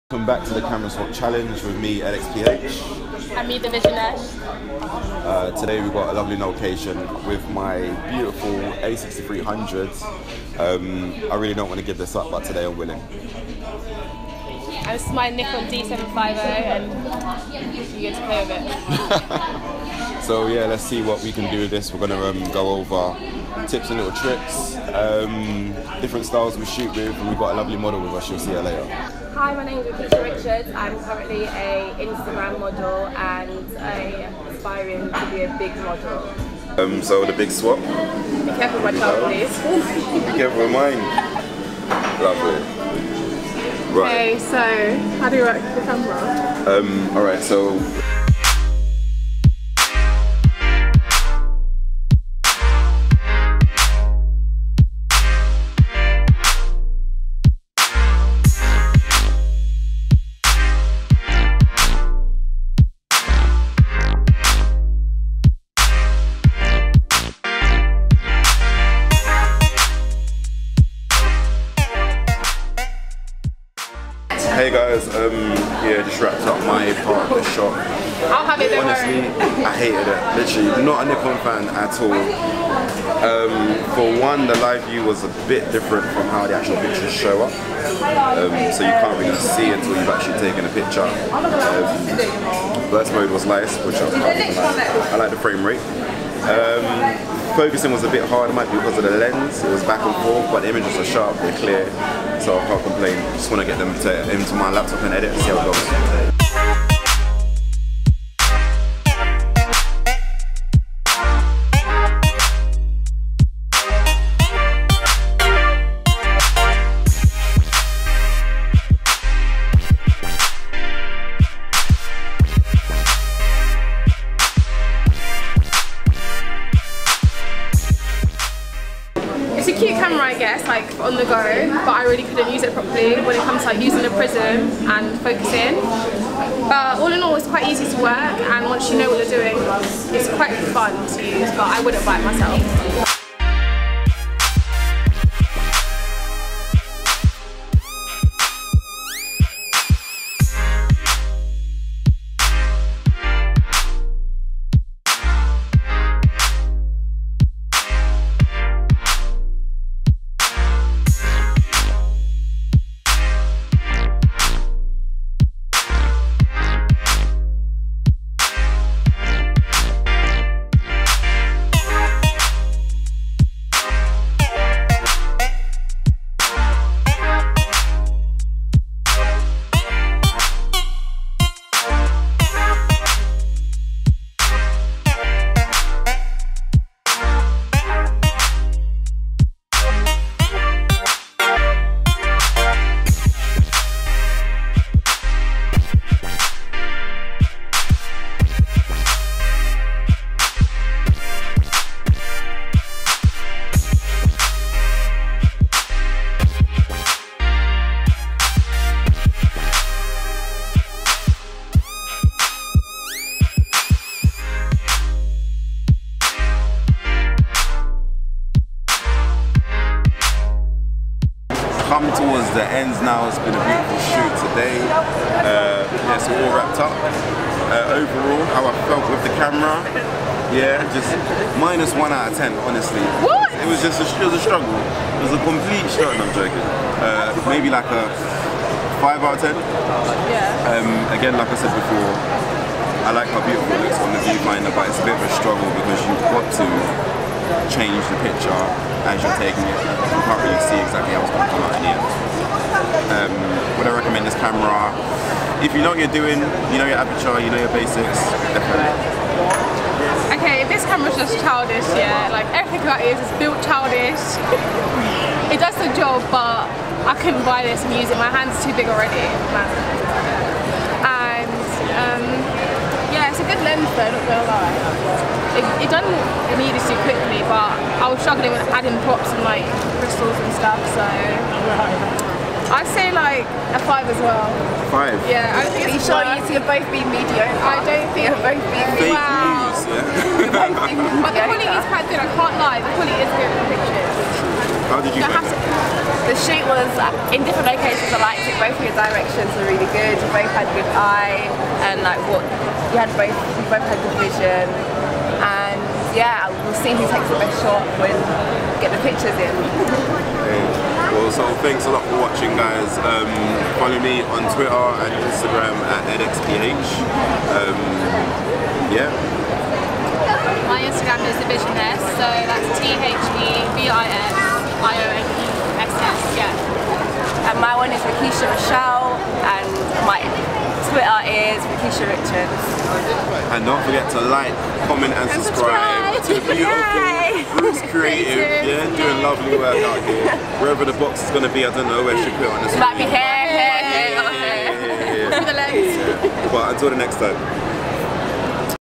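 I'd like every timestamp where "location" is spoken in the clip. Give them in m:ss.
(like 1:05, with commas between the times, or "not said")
0:06, 4:57.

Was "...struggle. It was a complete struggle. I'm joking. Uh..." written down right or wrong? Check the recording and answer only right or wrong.
right.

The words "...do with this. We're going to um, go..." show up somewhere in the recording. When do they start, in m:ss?
0:21.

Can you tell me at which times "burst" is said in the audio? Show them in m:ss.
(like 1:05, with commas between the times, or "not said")
1:32.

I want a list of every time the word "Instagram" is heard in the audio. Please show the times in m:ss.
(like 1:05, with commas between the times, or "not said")
0:31, 5:15, 5:20.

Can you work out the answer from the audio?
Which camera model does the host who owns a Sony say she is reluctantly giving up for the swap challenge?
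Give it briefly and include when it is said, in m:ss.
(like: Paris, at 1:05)
A6300, at 0:08.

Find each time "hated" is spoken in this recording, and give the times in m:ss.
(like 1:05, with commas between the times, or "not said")
1:19.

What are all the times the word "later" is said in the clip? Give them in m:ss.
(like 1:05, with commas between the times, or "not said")
0:28.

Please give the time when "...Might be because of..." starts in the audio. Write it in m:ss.
1:38.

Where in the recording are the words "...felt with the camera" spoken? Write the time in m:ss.
3:48.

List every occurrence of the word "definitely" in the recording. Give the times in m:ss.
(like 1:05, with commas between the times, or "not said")
4:18.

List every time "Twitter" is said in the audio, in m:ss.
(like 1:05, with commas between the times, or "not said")
5:14, 5:30.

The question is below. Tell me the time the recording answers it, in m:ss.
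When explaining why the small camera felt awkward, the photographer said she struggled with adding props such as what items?
4:40.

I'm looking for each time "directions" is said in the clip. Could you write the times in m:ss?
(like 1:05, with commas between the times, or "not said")
4:58.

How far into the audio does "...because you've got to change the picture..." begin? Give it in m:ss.
4:05.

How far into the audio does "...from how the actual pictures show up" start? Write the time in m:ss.
1:26.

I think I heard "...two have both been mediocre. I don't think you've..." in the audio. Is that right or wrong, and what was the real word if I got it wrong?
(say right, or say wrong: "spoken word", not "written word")
right.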